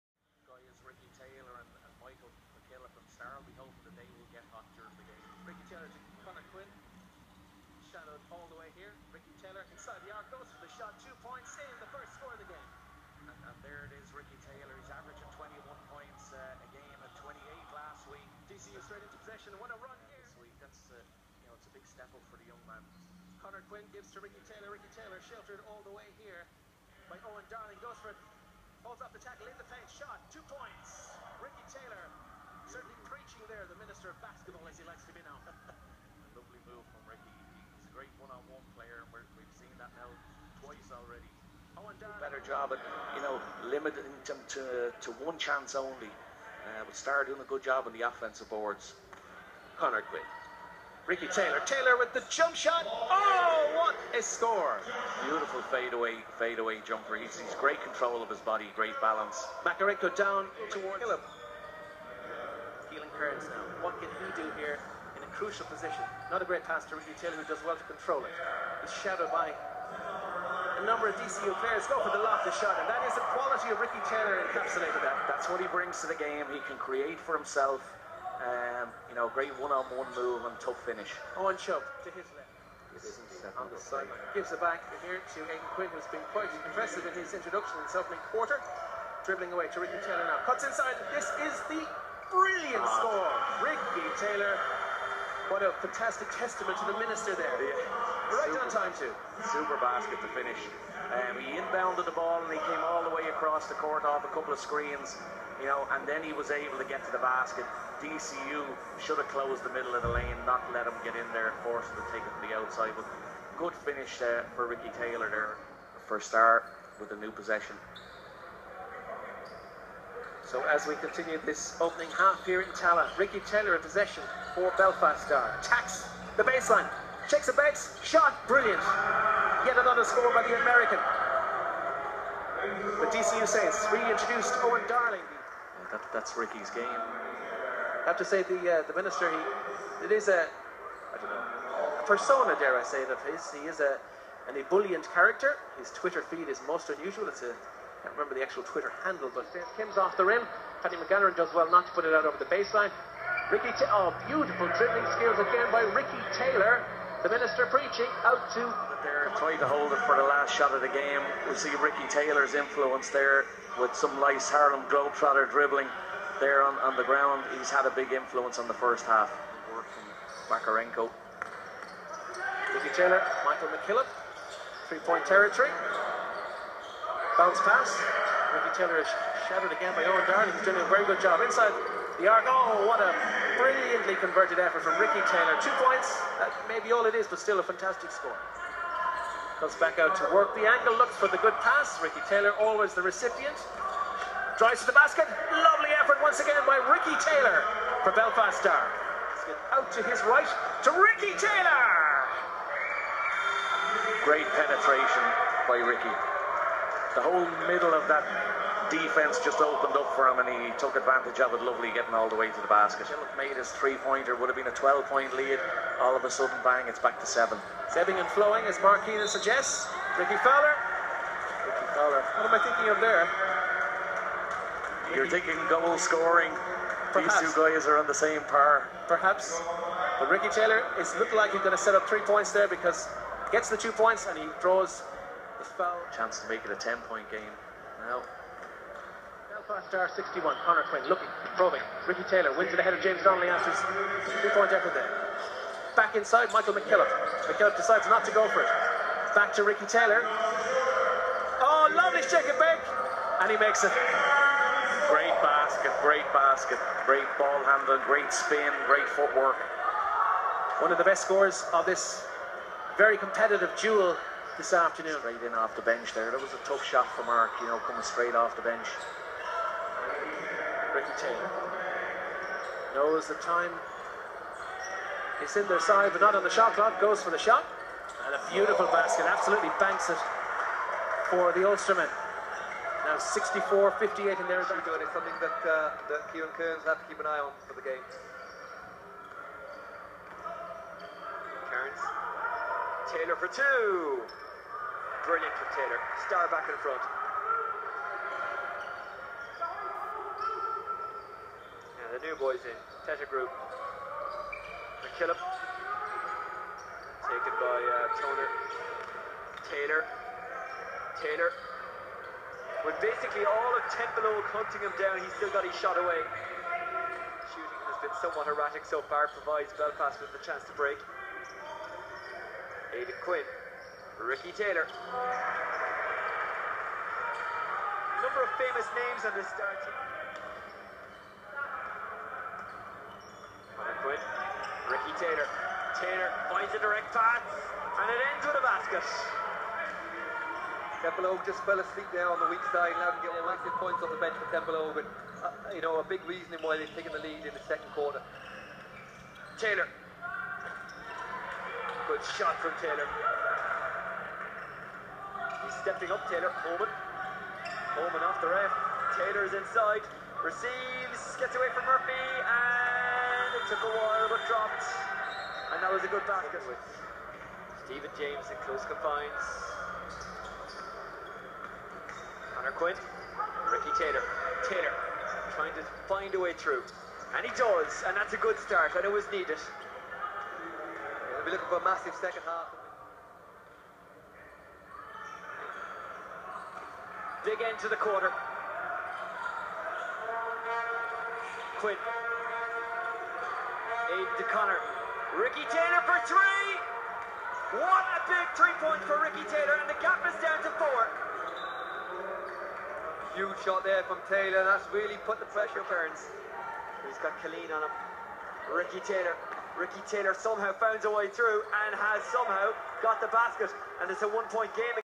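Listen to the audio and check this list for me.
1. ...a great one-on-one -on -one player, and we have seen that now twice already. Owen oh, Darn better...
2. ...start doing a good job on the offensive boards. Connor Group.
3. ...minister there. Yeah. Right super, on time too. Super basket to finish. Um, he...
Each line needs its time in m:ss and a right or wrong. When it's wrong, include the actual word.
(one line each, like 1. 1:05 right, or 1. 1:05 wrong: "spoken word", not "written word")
1. 0:37 right
2. 0:46 wrong: "Quinn", not "Group"
3. 1:36 right.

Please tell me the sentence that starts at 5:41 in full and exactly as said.
Templeogue just fell asleep there on the weak side, Now him to get massive points off the bench for Templeogue.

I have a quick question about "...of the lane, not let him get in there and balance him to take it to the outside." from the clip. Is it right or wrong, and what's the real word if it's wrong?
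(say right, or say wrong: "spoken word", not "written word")
wrong: "force", not "balance".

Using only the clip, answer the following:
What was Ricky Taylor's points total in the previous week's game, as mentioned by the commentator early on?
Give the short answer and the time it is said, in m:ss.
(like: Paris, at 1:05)
28, at 0:17.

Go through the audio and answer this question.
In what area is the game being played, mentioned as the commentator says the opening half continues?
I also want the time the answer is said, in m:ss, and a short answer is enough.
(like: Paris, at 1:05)
Tallaght, at 2:02.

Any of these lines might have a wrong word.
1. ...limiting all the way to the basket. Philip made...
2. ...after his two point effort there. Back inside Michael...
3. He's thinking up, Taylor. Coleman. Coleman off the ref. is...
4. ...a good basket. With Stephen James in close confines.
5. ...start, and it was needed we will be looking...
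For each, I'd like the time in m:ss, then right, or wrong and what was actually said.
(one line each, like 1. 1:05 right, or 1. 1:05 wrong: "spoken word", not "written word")
1. 3:31 wrong: "getting", not "limiting"
2. 4:03 right
3. 5:55 wrong: "stepping", not "thinking"
4. 6:06 right
5. 6:18 right.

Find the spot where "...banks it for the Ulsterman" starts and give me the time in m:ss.
4:39.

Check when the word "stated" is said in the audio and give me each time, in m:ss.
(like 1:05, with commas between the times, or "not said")
not said.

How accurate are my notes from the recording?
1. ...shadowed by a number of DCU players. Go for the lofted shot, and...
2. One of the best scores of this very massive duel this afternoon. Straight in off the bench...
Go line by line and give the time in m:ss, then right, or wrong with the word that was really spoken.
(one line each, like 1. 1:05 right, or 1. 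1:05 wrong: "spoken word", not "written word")
1. 1:09 right
2. 4:20 wrong: "competitive", not "massive".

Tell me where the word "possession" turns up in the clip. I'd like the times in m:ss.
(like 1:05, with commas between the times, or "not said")
0:19, 1:57, 2:03.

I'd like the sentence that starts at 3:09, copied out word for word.
Comes back out to work the angle, looks for the good pass.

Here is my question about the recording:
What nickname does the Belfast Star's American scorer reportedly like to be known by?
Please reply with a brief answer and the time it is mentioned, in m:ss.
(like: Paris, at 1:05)
The Minister of Basketball, at 0:33.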